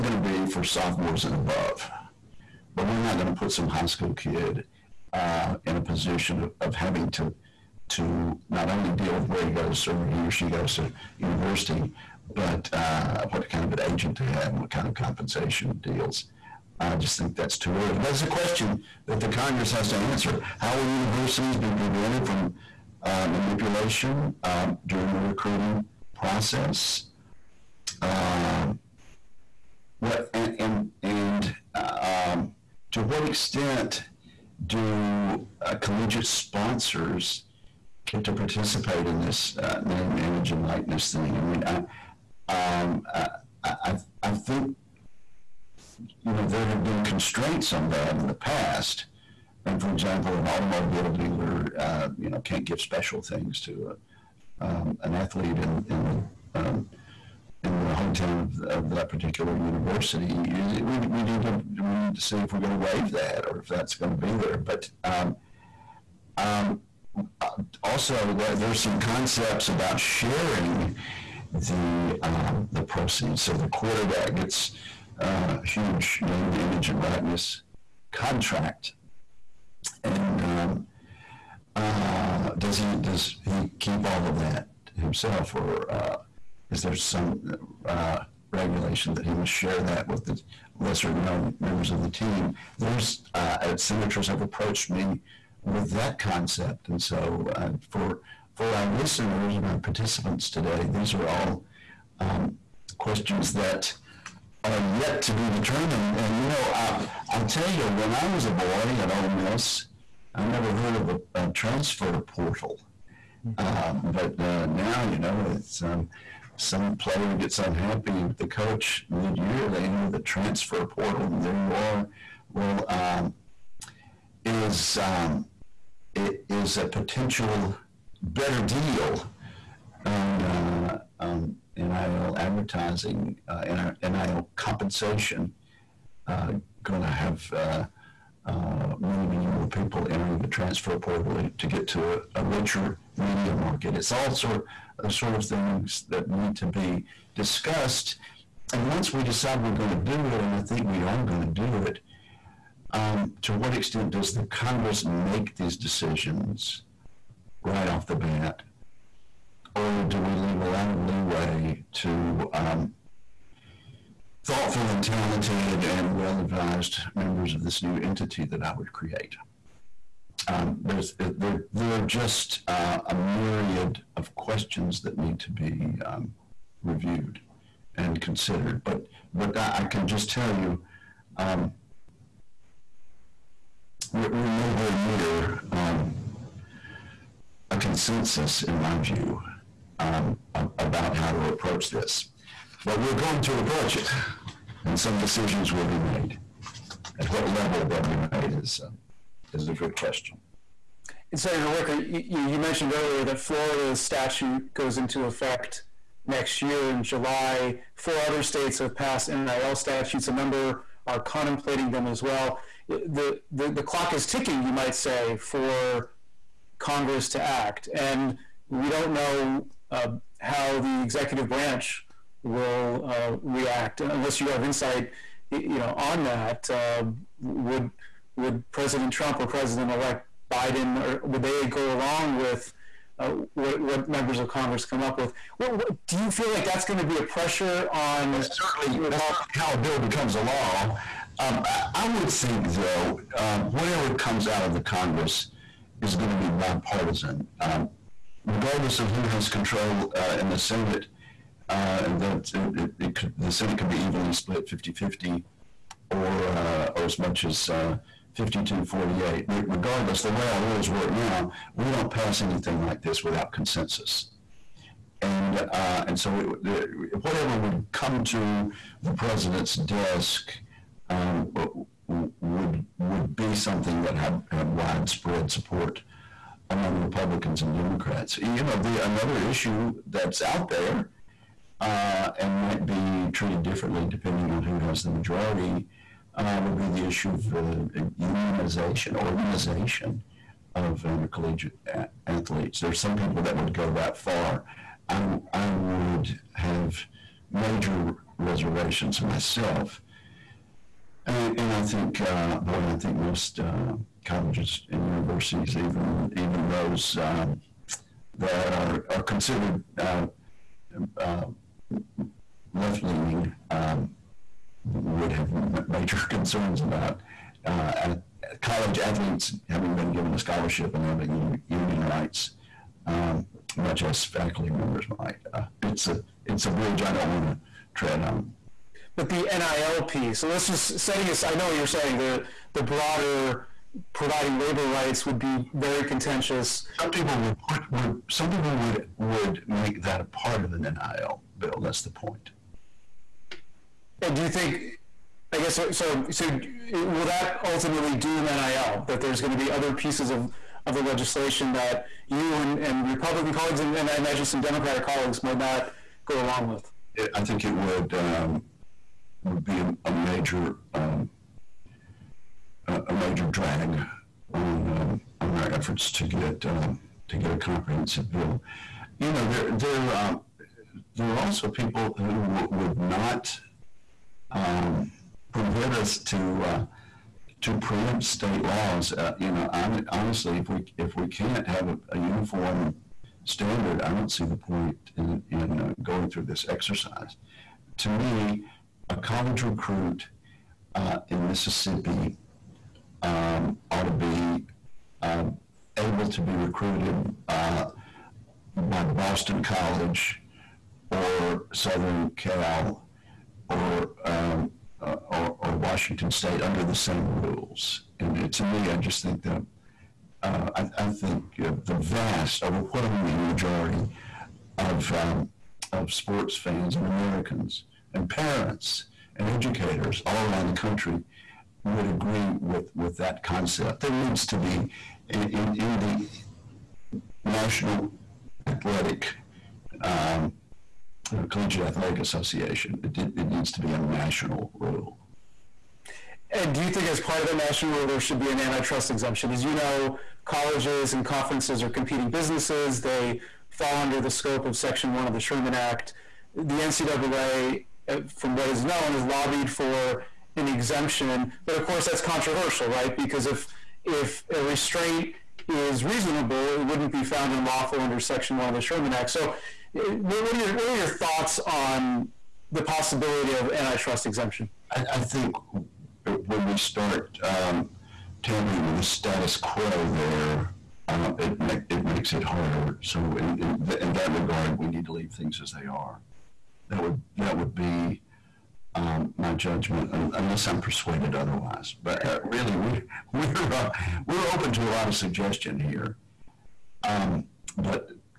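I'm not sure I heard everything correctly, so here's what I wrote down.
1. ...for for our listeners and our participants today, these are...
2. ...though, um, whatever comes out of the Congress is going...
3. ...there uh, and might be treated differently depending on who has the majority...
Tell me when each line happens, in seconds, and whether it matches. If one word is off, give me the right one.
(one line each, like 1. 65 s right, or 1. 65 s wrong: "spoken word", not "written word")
1. 97 s right
2. 242 s right
3. 280 s right.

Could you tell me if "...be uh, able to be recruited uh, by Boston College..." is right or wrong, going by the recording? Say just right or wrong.
right.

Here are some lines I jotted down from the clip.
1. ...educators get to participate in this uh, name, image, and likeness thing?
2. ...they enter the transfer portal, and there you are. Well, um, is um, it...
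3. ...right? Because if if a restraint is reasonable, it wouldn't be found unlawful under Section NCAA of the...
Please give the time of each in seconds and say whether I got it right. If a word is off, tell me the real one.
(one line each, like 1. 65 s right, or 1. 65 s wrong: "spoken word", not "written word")
1. 36 s wrong: "sponsors", not "educators"
2. 119 s right
3. 452 s wrong: "One", not "NCAA".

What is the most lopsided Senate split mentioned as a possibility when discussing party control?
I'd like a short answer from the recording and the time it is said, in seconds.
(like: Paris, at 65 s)
52-48, at 258 s.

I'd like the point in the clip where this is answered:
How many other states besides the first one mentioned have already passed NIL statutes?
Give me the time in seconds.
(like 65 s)
207 s.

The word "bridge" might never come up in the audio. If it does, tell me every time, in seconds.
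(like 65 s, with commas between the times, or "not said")
326 s.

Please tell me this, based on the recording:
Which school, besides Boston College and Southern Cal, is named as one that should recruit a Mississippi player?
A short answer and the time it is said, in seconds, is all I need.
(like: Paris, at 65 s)
Washington State, at 405 s.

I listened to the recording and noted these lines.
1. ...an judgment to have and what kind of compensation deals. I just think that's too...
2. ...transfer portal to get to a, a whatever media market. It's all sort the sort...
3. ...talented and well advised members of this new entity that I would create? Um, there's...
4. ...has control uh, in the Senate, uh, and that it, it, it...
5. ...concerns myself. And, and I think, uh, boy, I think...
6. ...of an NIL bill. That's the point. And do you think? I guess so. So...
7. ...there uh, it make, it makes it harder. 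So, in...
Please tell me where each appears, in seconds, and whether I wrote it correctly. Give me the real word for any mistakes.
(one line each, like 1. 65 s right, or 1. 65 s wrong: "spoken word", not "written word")
1. 13 s wrong: "agent", not "judgment"
2. 140 s wrong: "richer", not "whatever"
3. 165 s right
4. 249 s right
5. 298 s wrong: "reservations", not "concerns"
6. 340 s right
7. 470 s right.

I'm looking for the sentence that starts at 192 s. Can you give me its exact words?
But we're going to approach it, and some decisions will be made.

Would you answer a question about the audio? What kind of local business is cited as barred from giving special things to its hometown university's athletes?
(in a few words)
automobile dealer.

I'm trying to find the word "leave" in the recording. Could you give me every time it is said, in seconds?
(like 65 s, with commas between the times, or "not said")
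160 s, 475 s.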